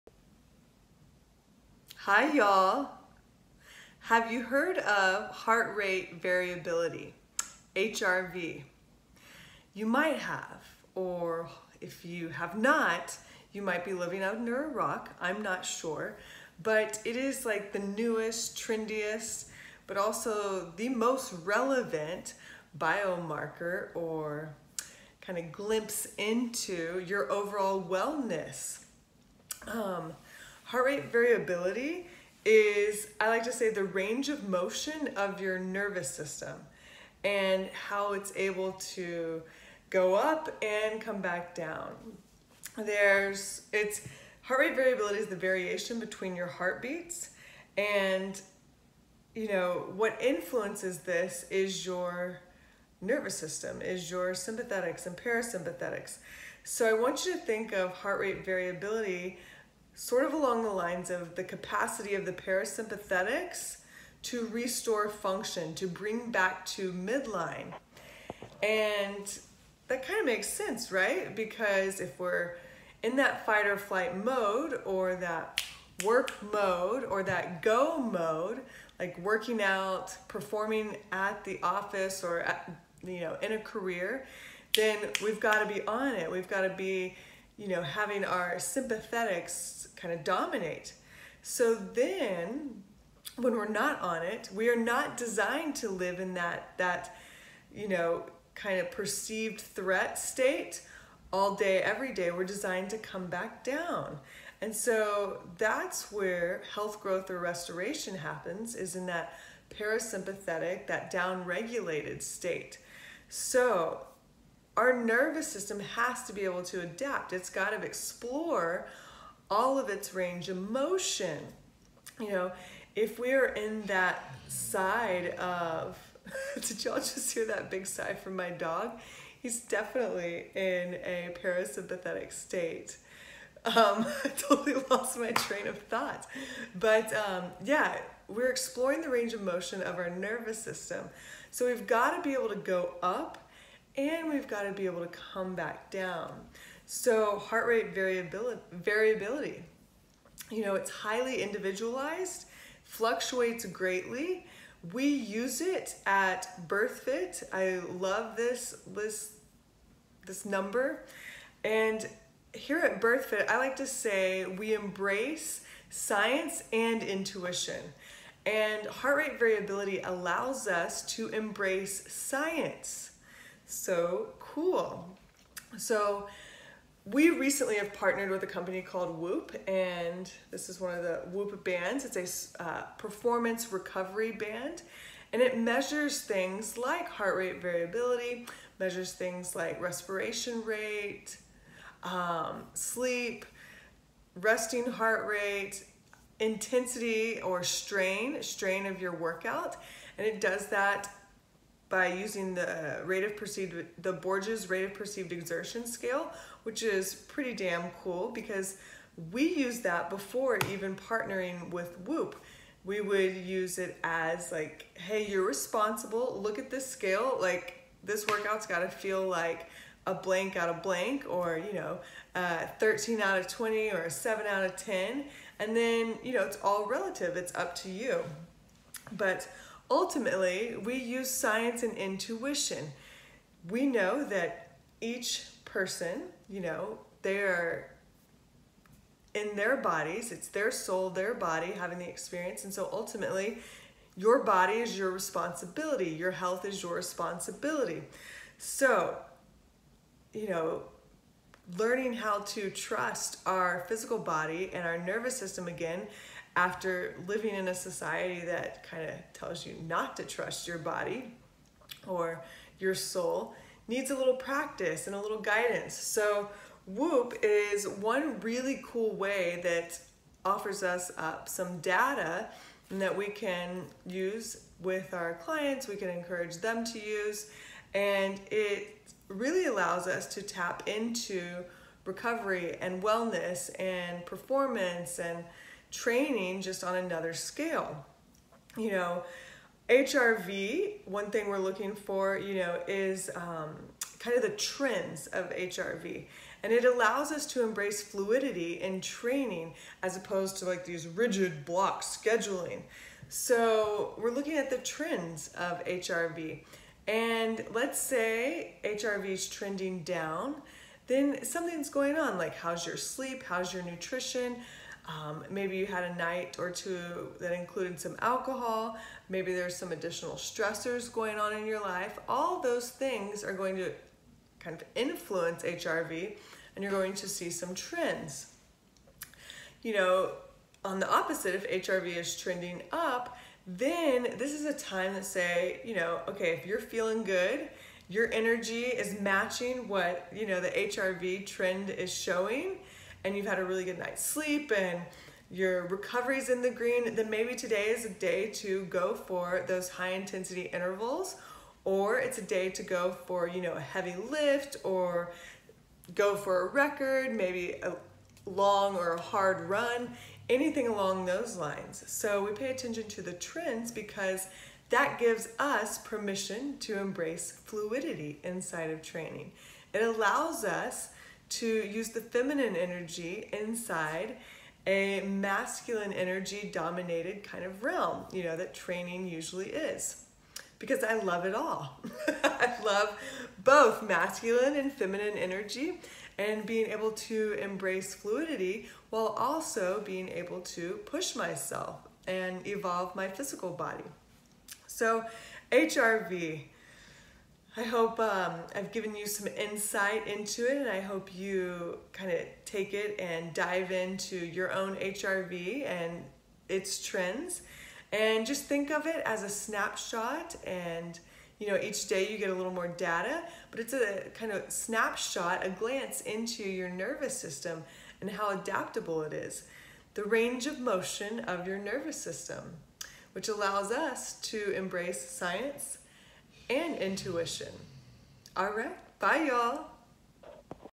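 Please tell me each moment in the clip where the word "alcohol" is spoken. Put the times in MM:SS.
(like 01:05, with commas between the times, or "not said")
05:18.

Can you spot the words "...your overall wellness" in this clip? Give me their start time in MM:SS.
00:27.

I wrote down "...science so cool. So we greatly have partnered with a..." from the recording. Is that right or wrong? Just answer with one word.
wrong.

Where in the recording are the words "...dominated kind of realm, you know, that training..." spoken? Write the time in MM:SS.
06:16.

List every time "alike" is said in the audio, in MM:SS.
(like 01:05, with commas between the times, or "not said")
not said.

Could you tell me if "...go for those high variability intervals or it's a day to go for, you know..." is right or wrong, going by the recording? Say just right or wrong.
wrong.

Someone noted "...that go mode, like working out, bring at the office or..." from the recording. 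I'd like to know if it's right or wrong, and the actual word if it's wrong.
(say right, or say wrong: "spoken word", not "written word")
wrong: "performing", not "bring".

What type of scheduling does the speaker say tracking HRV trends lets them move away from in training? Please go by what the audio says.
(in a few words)
Rigid block scheduling.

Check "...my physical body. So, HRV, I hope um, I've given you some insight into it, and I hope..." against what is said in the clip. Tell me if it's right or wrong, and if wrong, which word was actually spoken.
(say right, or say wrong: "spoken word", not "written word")
right.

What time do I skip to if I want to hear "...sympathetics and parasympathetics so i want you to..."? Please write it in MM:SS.
00:54.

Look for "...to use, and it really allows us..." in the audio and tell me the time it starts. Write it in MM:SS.
04:36.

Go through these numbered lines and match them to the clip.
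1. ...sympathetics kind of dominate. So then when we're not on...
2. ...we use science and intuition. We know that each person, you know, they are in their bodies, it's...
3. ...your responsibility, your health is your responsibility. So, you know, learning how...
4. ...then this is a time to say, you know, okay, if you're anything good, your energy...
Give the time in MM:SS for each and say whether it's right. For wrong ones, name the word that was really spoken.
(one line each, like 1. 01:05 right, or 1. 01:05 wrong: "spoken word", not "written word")
1. 01:28 right
2. 03:50 right
3. 04:04 right
4. 05:33 wrong: "feeling", not "anything".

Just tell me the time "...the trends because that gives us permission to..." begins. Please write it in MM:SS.
06:03.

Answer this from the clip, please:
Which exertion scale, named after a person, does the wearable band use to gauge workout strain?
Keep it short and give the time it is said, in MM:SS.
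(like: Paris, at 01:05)
Borg's rate of perceived exertion scale, at 03:24.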